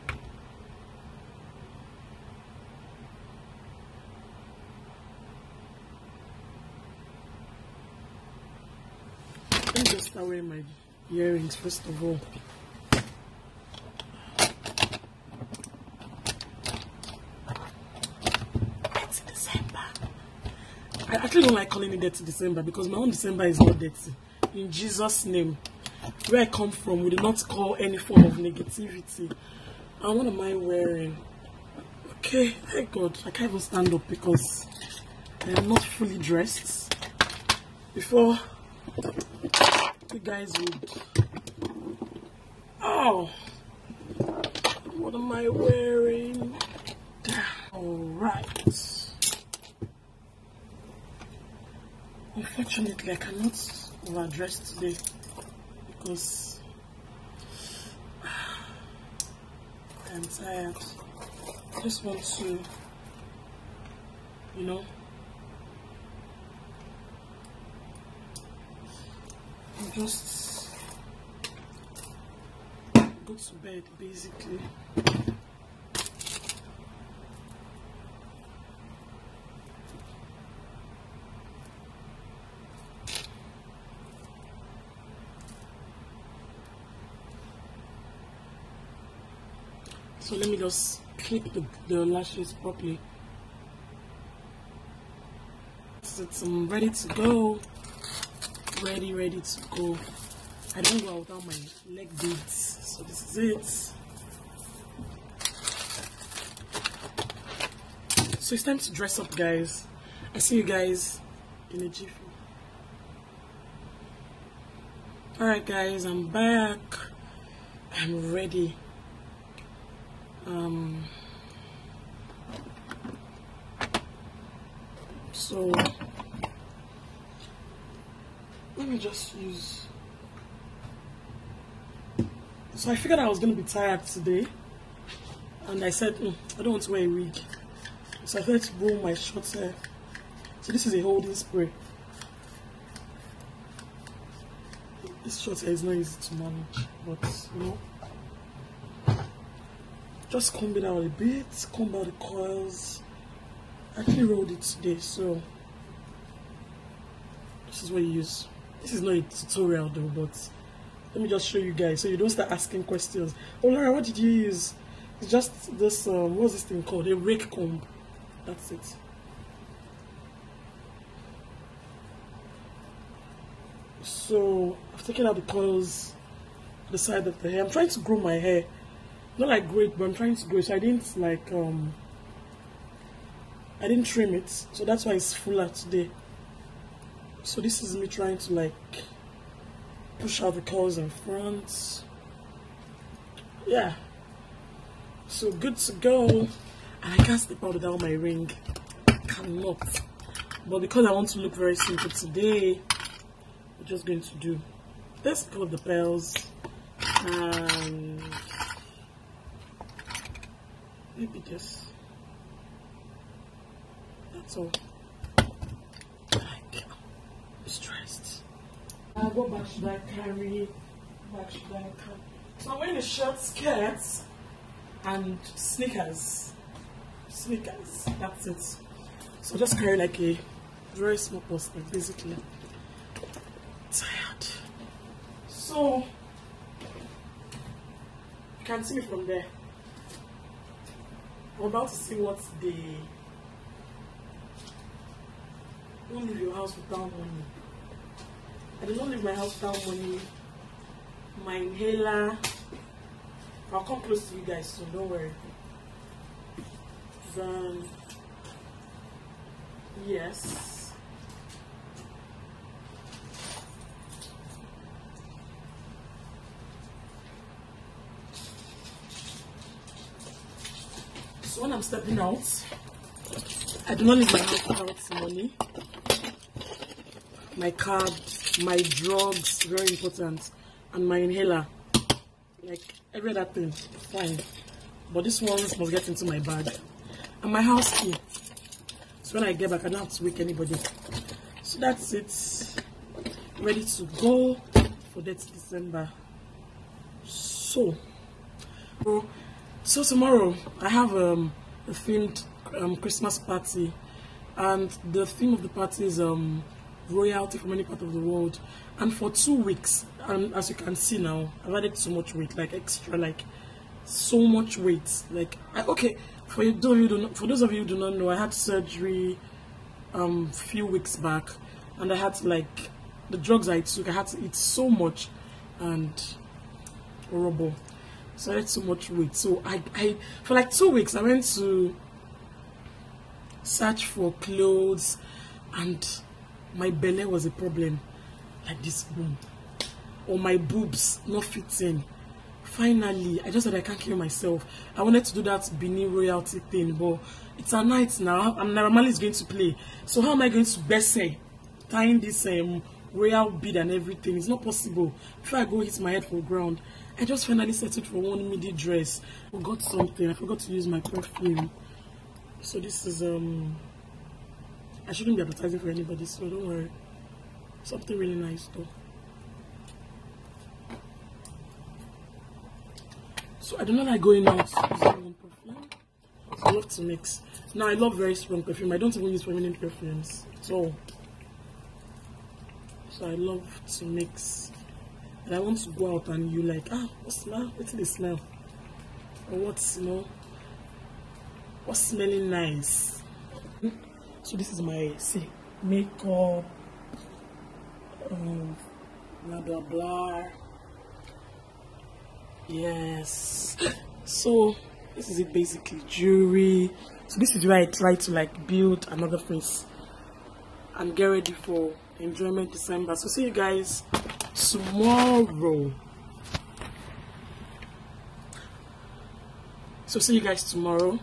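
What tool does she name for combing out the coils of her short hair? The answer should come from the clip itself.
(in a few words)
rake comb.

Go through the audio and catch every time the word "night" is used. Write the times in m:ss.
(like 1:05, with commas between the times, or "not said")
5:47.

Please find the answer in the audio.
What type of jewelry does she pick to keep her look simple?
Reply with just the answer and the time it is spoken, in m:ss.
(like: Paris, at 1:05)
pearls, at 3:25.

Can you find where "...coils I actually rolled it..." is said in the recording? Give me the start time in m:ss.
2:32.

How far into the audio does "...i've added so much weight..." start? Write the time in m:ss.
5:11.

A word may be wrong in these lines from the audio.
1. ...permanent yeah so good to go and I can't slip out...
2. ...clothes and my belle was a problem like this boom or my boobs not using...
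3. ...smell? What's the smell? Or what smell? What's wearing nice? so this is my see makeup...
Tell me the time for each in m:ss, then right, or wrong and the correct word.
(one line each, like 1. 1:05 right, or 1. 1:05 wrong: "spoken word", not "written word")
1. 3:11 wrong: "front", not "permanent"
2. 5:34 wrong: "fitting", not "using"
3. 6:27 wrong: "smelling", not "wearing".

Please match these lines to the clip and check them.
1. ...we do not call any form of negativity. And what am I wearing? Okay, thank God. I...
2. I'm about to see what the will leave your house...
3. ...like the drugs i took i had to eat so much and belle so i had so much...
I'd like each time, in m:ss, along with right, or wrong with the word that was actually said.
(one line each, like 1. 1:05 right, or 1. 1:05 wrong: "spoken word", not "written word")
1. 0:27 right
2. 4:01 right
3. 5:22 wrong: "horrible", not "belle".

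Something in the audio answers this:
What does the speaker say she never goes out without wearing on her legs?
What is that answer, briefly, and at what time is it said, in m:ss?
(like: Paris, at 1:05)
leg beads, at 1:41.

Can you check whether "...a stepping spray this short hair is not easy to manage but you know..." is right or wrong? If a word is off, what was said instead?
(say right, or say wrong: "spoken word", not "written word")
wrong: "holding", not "stepping".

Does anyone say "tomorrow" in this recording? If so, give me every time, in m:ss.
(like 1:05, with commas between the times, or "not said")
5:00, 6:54, 7:00.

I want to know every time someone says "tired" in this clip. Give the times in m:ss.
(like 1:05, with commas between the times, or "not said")
1:00, 2:13, 3:53.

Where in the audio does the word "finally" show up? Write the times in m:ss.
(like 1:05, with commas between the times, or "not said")
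5:42, 5:57.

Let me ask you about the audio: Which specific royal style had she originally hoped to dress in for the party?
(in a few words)
Benin royalty.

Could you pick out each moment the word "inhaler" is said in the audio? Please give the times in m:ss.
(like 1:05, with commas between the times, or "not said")
4:11, 4:41.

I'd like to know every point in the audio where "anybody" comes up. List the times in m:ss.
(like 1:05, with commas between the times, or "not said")
4:50, 6:05.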